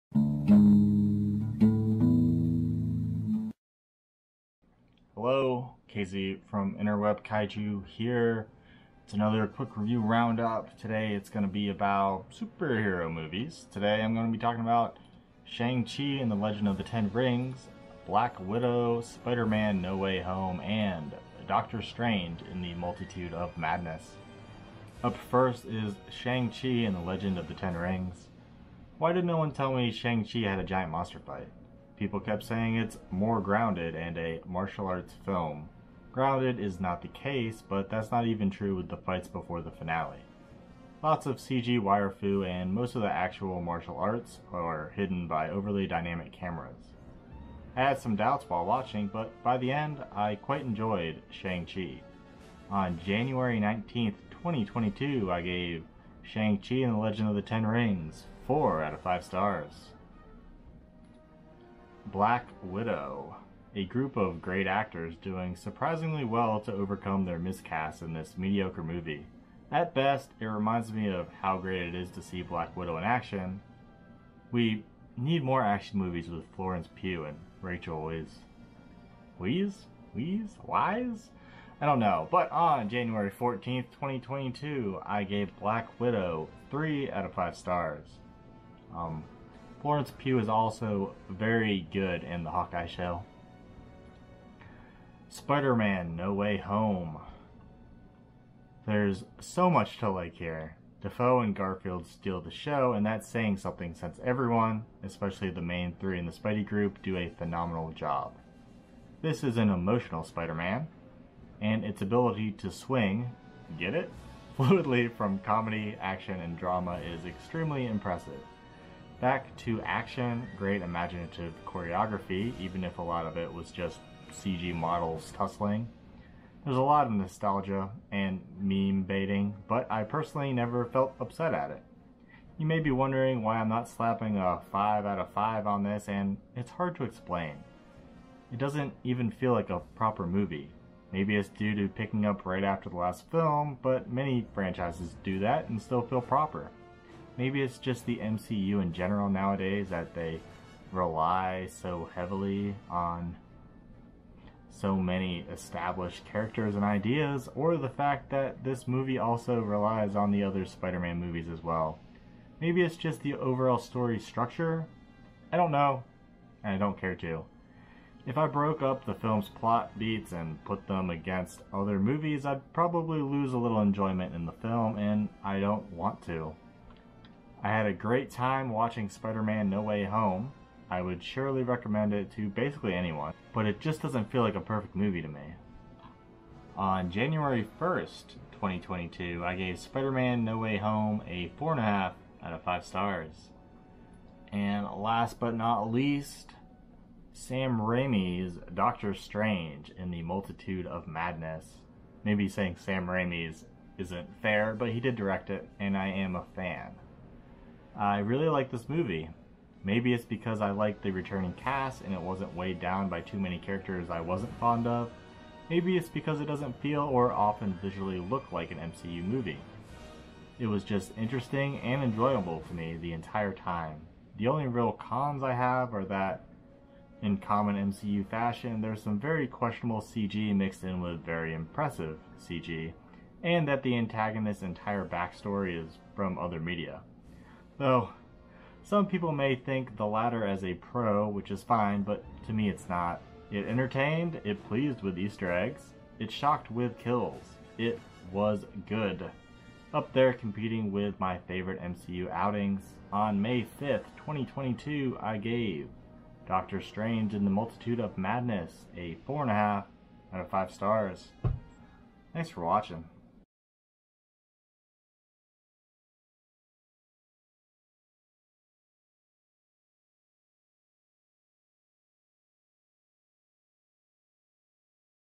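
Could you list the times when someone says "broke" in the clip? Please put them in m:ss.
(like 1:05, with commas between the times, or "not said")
2:48.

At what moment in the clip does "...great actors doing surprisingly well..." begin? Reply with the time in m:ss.
1:04.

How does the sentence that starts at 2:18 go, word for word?
It doesn't even feel like a proper movie.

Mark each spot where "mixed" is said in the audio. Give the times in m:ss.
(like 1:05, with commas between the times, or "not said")
3:50.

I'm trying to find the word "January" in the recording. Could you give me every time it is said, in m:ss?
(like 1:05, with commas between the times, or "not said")
0:53, 1:22, 3:07.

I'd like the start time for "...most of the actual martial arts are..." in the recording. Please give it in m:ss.
0:42.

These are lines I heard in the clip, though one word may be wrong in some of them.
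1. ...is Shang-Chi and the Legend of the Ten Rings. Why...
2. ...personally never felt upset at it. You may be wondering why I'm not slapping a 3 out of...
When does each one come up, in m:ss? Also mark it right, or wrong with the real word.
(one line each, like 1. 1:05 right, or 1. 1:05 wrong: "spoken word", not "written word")
1. 0:25 right
2. 2:10 wrong: "5", not "3".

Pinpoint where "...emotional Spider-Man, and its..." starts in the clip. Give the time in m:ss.
1:49.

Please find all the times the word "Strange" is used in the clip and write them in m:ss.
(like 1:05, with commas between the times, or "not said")
0:21, 3:19, 4:16.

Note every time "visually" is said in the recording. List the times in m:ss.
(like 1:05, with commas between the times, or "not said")
3:37.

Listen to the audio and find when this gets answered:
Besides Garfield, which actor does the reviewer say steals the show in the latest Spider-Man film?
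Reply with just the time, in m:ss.
1:41.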